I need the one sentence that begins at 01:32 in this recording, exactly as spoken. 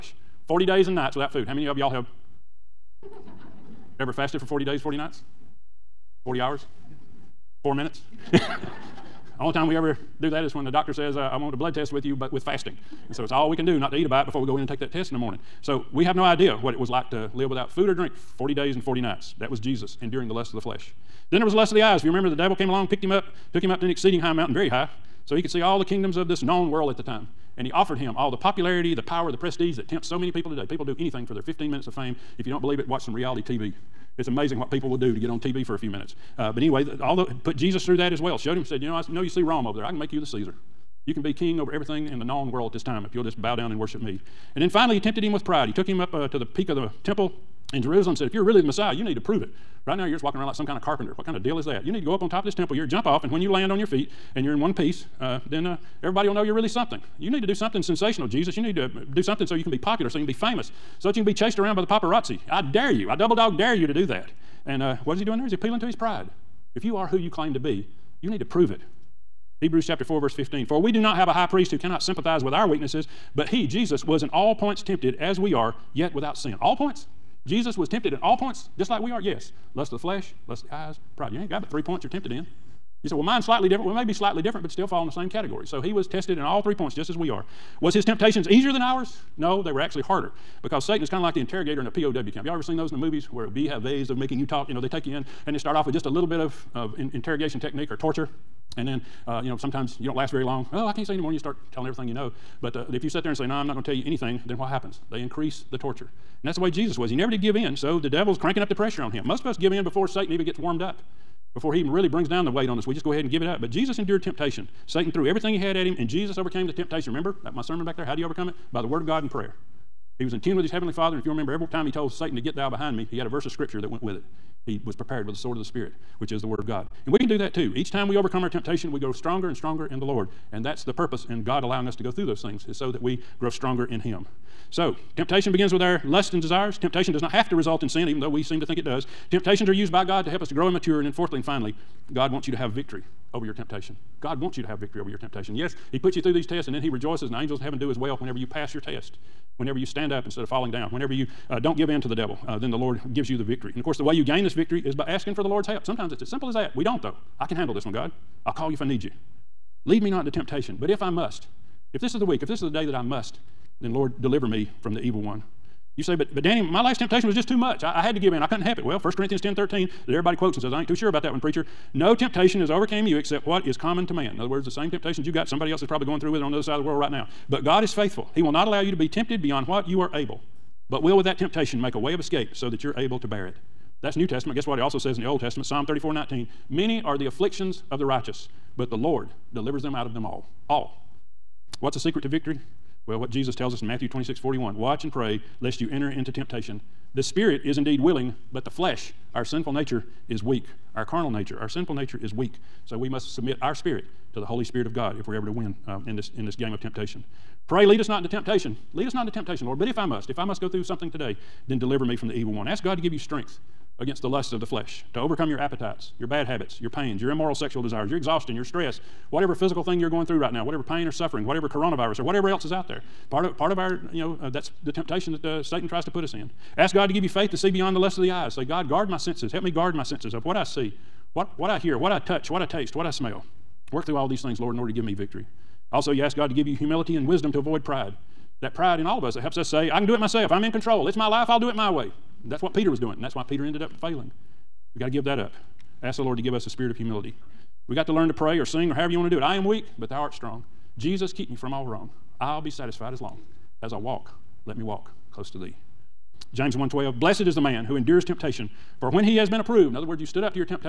Y'all ever seen those in the movies where we have ways of making you talk?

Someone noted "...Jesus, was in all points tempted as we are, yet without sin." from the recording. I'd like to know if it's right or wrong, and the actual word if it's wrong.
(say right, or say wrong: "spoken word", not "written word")
right.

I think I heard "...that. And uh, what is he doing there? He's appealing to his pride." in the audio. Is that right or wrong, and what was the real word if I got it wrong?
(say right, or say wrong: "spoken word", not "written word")
right.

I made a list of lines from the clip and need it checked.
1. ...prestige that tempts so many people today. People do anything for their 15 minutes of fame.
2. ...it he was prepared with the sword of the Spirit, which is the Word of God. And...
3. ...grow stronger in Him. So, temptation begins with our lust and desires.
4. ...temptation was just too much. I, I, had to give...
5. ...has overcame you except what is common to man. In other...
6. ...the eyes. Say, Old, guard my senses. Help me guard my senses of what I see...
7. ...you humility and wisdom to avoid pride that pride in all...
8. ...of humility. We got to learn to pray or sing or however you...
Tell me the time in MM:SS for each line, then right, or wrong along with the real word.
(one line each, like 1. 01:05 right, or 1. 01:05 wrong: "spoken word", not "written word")
1. 00:29 right
2. 02:04 right
3. 02:13 right
4. 02:46 right
5. 02:52 right
6. 03:48 wrong: "God", not "Old"
7. 03:56 right
8. 04:06 right.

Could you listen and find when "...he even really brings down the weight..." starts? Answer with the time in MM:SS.
01:51.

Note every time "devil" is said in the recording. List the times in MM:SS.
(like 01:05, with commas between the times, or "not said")
00:22, 01:48, 02:32.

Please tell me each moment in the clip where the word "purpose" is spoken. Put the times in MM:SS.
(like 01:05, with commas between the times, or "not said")
02:10.